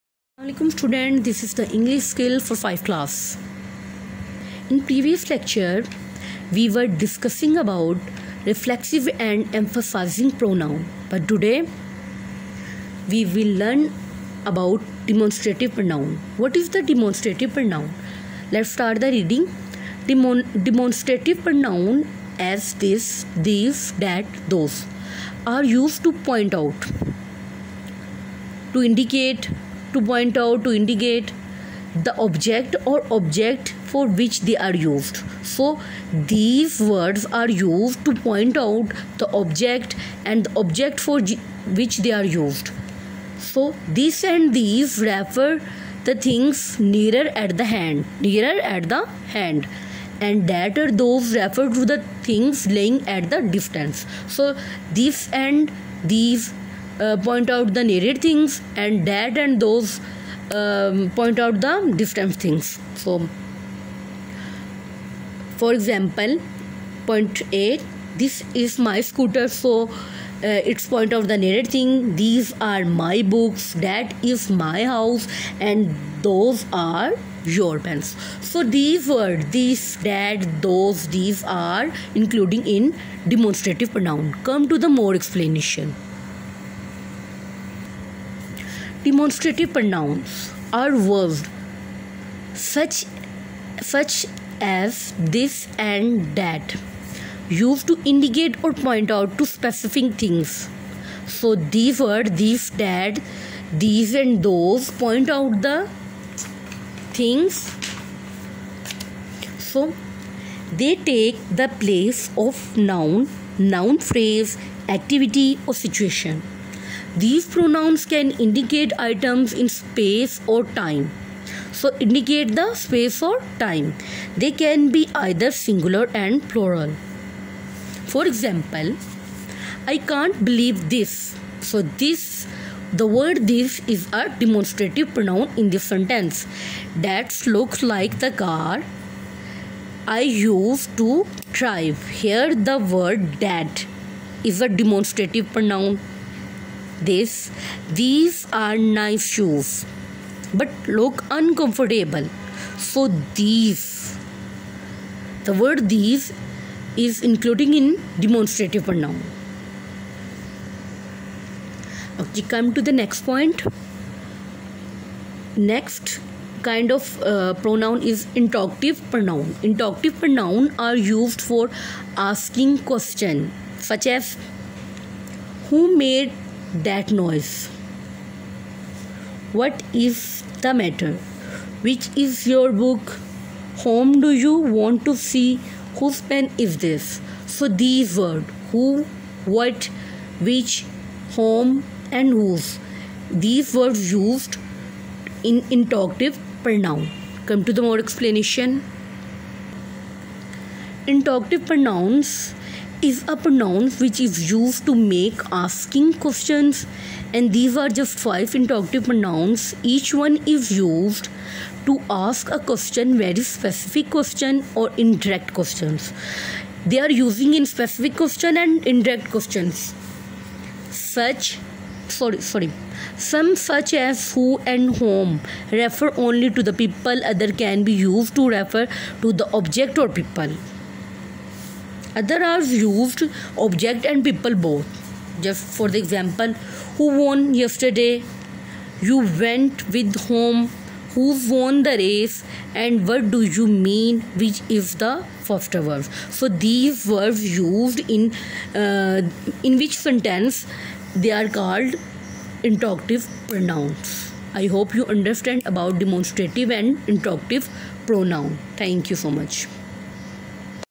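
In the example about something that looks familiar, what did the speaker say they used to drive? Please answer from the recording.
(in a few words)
The car.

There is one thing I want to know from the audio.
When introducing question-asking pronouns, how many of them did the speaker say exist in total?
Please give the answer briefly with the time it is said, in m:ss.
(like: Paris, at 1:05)
5, at 3:28.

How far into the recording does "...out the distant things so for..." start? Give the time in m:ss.
1:01.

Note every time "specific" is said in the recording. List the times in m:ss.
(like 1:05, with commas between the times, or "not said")
1:39, 3:33, 3:37.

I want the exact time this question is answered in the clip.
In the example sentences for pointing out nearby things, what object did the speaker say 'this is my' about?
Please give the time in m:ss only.
1:09.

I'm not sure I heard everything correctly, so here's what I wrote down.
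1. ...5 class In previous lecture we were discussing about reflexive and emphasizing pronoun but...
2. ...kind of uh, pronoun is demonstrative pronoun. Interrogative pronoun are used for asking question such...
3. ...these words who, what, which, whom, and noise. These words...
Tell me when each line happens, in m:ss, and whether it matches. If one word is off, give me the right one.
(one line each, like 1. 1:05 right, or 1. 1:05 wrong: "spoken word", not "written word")
1. 0:02 right
2. 2:46 wrong: "interrogative", not "demonstrative"
3. 3:07 wrong: "whose", not "noise".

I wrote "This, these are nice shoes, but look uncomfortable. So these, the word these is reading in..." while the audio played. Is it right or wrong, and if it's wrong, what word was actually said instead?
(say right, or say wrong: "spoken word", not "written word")
wrong: "including", not "reading".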